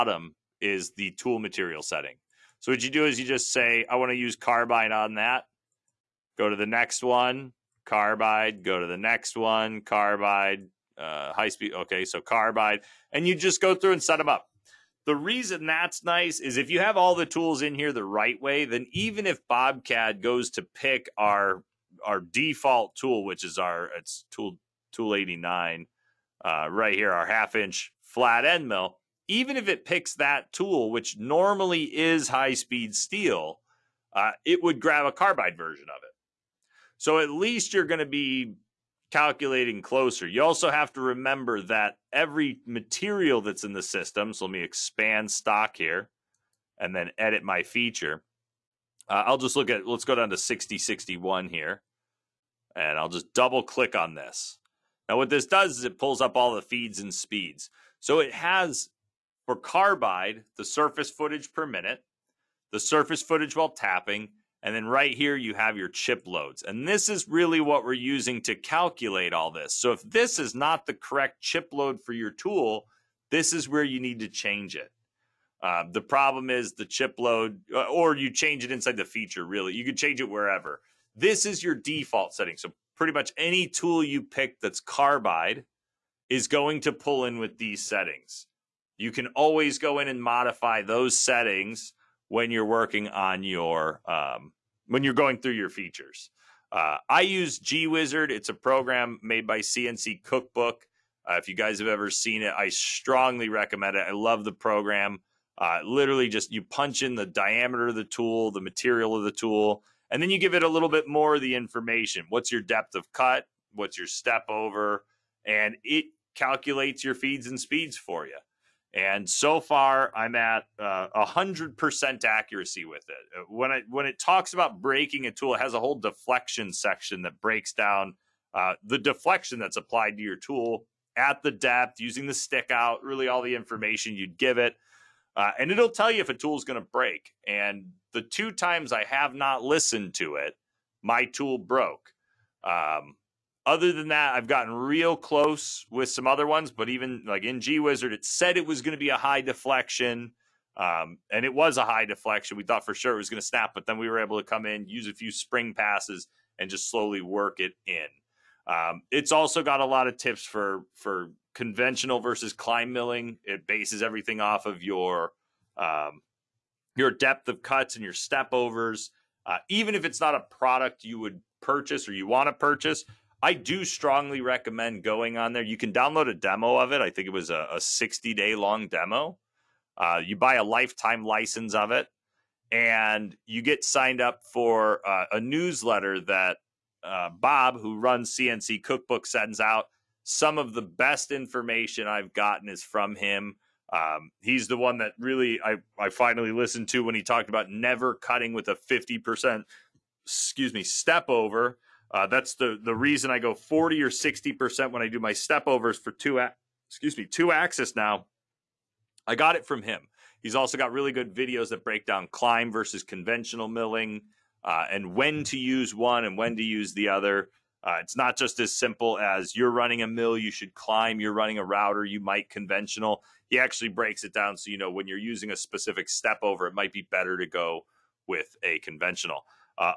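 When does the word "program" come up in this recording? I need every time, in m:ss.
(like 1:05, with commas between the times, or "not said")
1:38, 1:44.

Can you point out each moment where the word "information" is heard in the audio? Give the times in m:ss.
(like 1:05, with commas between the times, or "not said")
1:51, 2:13, 3:11.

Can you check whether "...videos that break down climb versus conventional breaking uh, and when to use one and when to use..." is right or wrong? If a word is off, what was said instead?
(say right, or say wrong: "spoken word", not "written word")
wrong: "milling", not "breaking".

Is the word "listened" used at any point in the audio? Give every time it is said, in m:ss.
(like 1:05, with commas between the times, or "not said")
2:19, 3:16.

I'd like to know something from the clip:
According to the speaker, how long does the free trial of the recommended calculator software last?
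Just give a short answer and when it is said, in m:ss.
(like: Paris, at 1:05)
60 days, at 2:57.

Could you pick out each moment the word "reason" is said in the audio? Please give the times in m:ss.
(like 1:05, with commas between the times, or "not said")
0:15, 3:22.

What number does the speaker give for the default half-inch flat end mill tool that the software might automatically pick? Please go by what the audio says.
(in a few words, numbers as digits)
89.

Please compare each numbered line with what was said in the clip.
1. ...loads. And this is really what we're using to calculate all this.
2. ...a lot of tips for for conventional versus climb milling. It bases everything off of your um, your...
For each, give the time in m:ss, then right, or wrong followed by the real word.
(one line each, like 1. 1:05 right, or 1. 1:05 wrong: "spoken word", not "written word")
1. 1:06 right
2. 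2:39 right.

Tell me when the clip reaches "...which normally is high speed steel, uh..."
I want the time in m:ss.
0:30.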